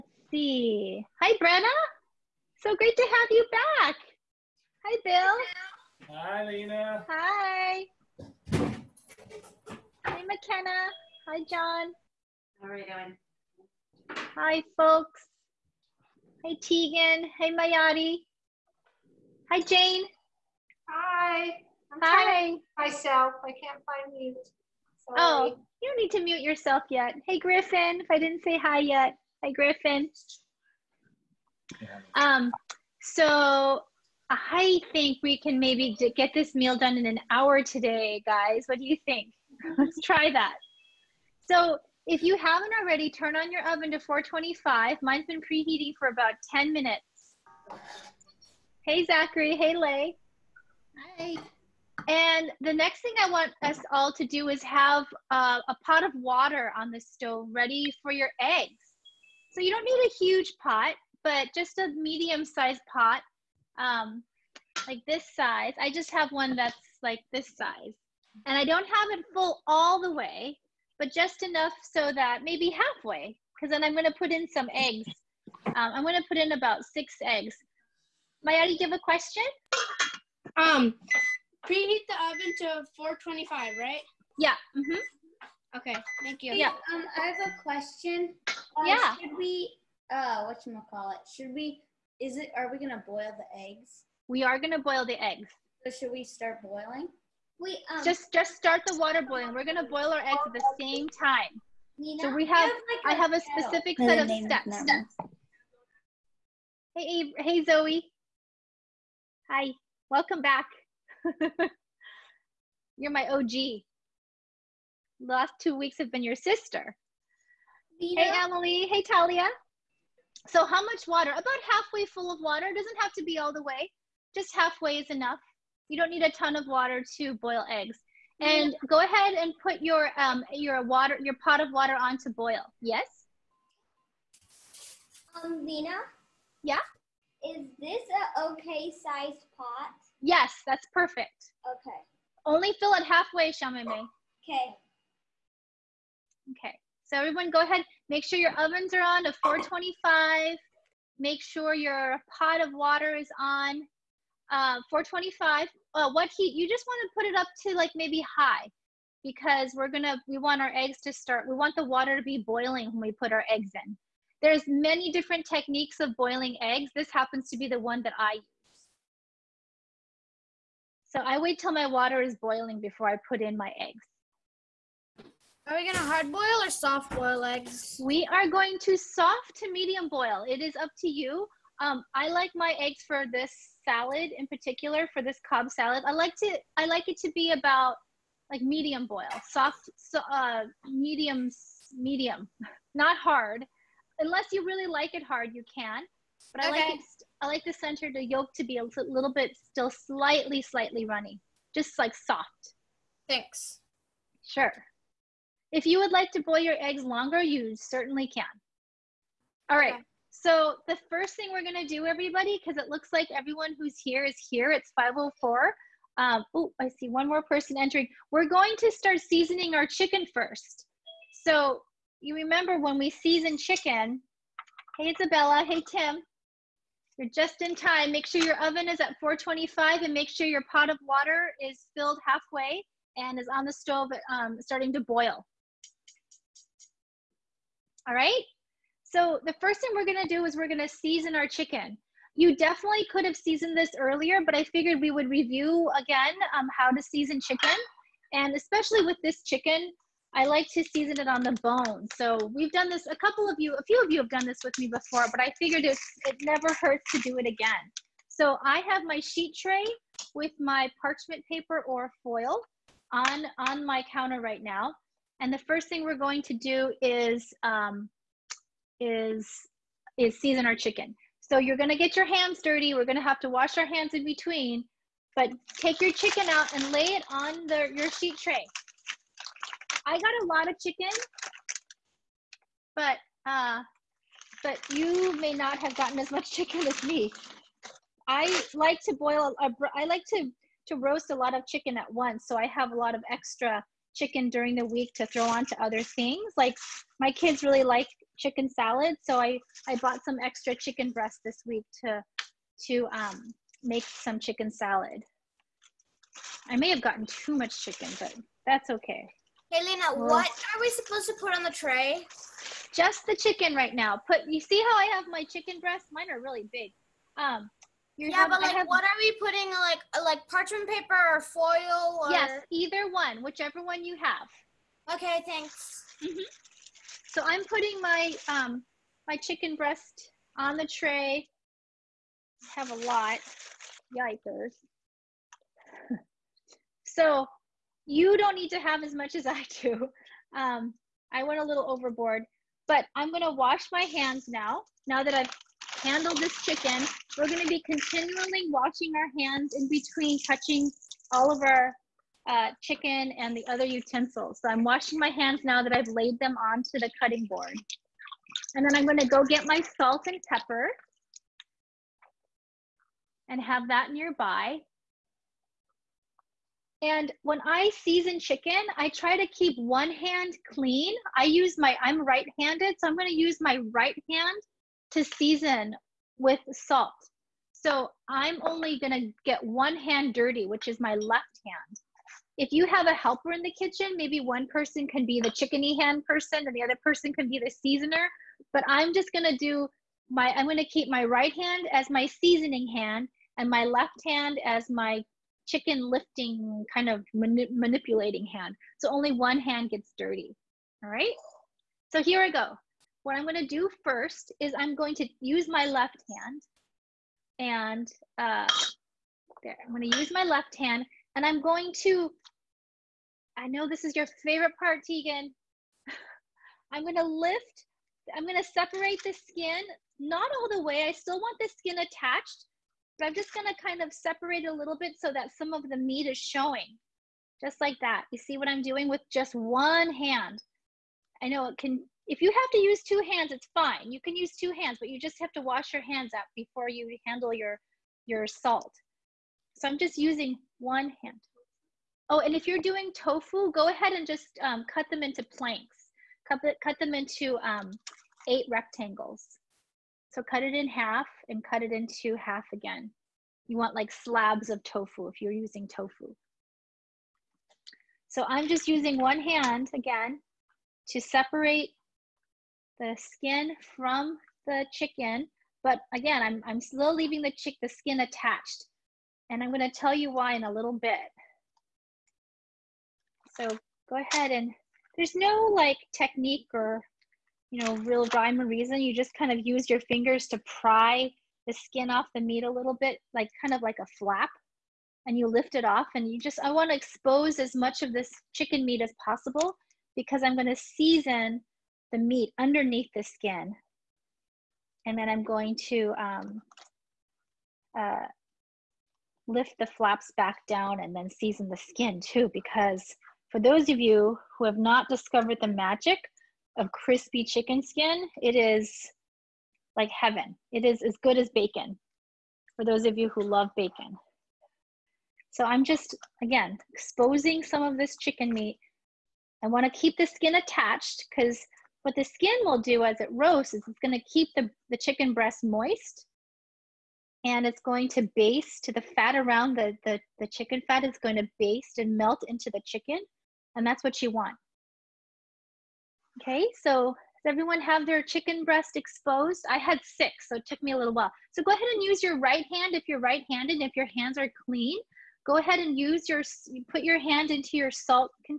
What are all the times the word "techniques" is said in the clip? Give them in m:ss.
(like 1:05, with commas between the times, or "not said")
2:45, 7:56.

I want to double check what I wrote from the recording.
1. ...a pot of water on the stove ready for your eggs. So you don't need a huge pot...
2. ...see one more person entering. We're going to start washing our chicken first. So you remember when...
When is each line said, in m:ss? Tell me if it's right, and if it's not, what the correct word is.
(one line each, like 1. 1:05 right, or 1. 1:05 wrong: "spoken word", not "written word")
1. 0:55 right
2. 3:36 wrong: "seasoning", not "washing".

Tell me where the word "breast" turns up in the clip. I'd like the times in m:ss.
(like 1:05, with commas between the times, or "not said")
5:01, 5:15, 5:29, 8:45, 8:58.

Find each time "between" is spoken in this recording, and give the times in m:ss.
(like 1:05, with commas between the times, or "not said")
4:34, 5:49.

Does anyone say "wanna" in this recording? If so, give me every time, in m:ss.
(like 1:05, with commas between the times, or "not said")
8:06, 8:39.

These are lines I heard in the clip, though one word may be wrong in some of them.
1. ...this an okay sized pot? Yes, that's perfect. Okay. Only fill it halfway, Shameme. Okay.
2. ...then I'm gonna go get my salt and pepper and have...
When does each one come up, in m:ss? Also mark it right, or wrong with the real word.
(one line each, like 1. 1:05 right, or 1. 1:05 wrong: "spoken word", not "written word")
1. 2:17 right
2. 5:58 right.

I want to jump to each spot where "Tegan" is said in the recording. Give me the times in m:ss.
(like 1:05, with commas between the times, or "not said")
0:16, 6:55.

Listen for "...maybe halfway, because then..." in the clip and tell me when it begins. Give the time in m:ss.
1:12.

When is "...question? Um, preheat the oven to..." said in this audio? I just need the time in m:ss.
1:18.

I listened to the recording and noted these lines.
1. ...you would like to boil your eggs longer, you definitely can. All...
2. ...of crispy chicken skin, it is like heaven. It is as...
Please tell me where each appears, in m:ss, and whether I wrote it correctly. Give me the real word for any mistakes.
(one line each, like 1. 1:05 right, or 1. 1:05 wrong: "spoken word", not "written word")
1. 3:25 wrong: "certainly", not "definitely"
2. 8:26 right.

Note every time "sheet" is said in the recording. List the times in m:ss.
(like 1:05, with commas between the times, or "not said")
4:19, 4:38.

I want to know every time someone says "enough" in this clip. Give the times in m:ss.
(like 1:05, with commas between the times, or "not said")
1:11, 2:05.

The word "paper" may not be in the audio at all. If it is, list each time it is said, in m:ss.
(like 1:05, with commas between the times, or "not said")
4:21, 5:20.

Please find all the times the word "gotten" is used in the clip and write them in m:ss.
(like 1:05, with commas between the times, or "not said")
4:45, 5:07.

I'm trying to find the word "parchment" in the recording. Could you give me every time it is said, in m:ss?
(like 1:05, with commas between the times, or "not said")
4:20, 5:20.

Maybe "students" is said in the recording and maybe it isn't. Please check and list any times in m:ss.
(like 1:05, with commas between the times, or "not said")
not said.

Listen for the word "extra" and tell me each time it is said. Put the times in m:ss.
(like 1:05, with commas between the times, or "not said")
4:53, 5:00.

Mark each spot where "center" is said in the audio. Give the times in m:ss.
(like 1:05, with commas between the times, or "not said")
3:17.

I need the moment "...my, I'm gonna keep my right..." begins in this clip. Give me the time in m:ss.
6:30.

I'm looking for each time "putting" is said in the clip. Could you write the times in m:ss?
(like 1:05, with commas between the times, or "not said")
5:19, 5:27.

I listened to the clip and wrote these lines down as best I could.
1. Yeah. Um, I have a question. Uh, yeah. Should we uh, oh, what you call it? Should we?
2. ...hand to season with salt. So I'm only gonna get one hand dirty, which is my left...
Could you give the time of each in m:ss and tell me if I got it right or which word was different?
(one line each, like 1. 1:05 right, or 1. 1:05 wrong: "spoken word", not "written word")
1. 1:26 right
2. 6:14 right.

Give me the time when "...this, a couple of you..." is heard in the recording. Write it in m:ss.
4:12.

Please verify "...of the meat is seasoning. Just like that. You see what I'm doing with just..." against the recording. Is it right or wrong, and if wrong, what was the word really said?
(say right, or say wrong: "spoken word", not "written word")
wrong: "showing", not "seasoning".